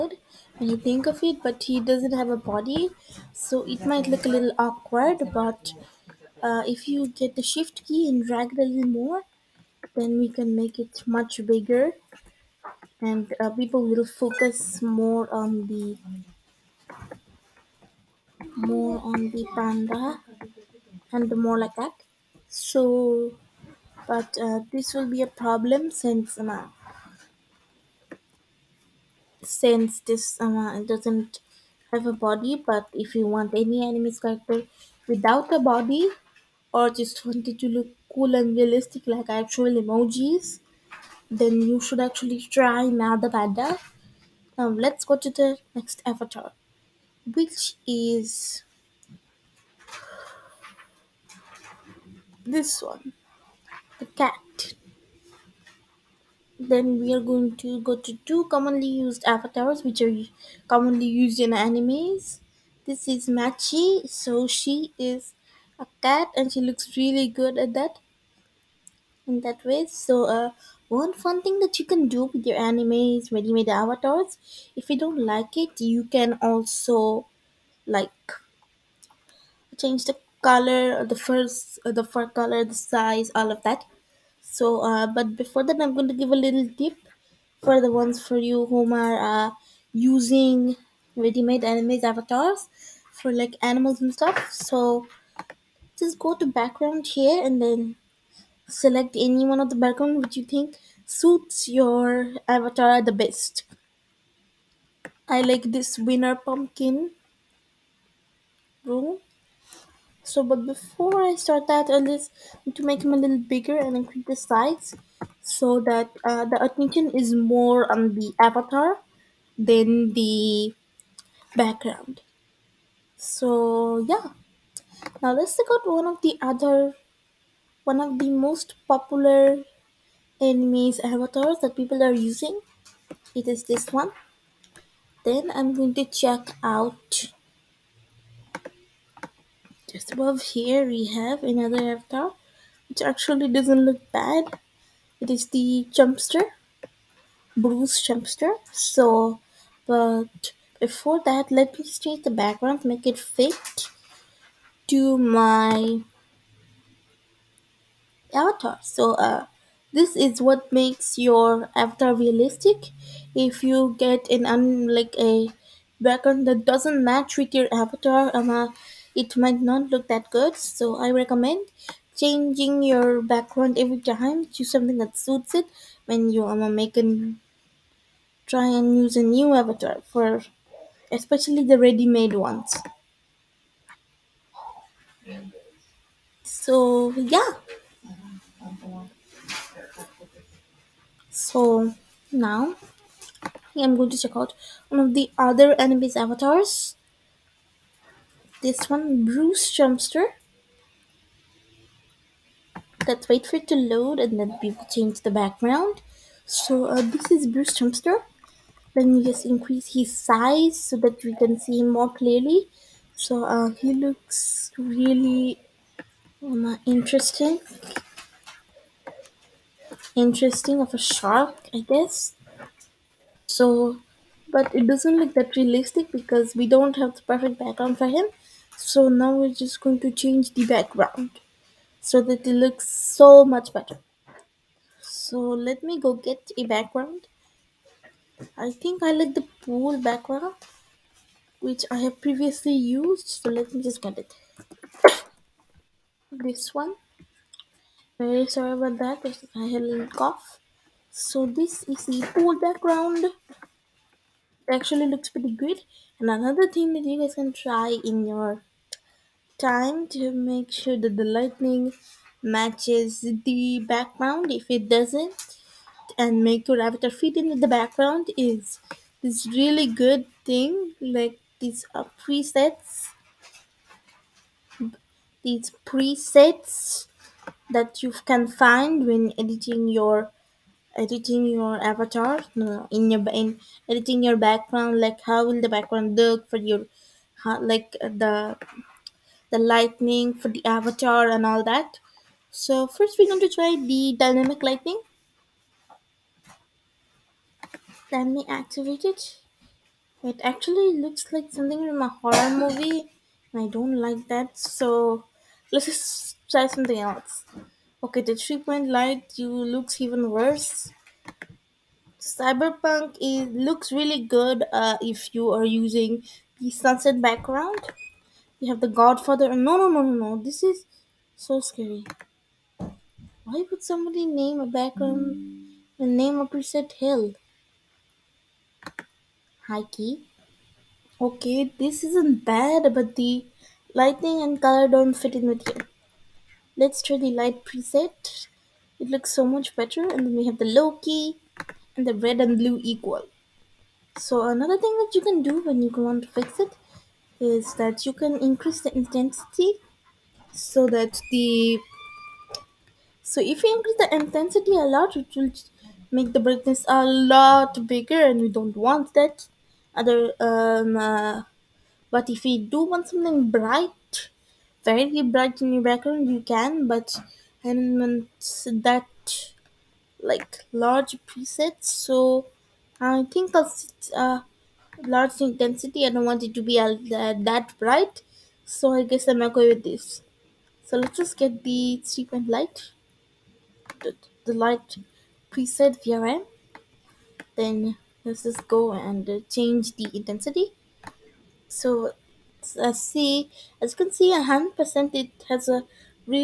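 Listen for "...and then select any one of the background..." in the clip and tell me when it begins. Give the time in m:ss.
1:37.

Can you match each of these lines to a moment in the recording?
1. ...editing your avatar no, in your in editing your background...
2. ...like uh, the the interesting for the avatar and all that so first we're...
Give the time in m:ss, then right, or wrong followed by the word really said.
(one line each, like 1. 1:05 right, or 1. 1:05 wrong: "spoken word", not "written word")
1. 4:40 right
2. 4:47 wrong: "lightning", not "interesting".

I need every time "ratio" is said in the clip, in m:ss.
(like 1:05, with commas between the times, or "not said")
not said.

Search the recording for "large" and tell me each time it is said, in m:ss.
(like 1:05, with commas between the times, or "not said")
6:10, 6:15.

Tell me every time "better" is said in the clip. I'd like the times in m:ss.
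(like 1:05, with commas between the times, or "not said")
3:53, 5:39.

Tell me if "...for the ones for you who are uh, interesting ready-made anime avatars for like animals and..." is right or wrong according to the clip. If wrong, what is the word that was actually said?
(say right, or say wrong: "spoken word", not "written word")
wrong: "using", not "interesting".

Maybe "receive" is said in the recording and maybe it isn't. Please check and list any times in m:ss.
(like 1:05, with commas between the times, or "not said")
not said.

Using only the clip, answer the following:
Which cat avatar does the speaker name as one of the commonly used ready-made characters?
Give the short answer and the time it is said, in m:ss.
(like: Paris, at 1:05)
Machi, at 1:03.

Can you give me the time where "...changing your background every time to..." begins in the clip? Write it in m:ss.
2:52.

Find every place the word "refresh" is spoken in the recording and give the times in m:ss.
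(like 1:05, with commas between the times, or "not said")
not said.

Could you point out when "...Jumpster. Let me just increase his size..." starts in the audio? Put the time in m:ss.
3:27.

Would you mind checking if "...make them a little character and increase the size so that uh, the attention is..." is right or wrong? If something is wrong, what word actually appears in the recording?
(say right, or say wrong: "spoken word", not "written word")
wrong: "bigger", not "character".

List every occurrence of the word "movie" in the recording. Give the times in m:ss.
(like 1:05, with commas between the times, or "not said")
5:02.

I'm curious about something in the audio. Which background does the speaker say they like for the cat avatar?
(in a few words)
winner pumpkin room.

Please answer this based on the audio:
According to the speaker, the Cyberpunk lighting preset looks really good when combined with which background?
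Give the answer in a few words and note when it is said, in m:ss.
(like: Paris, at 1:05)
sunset background, at 5:16.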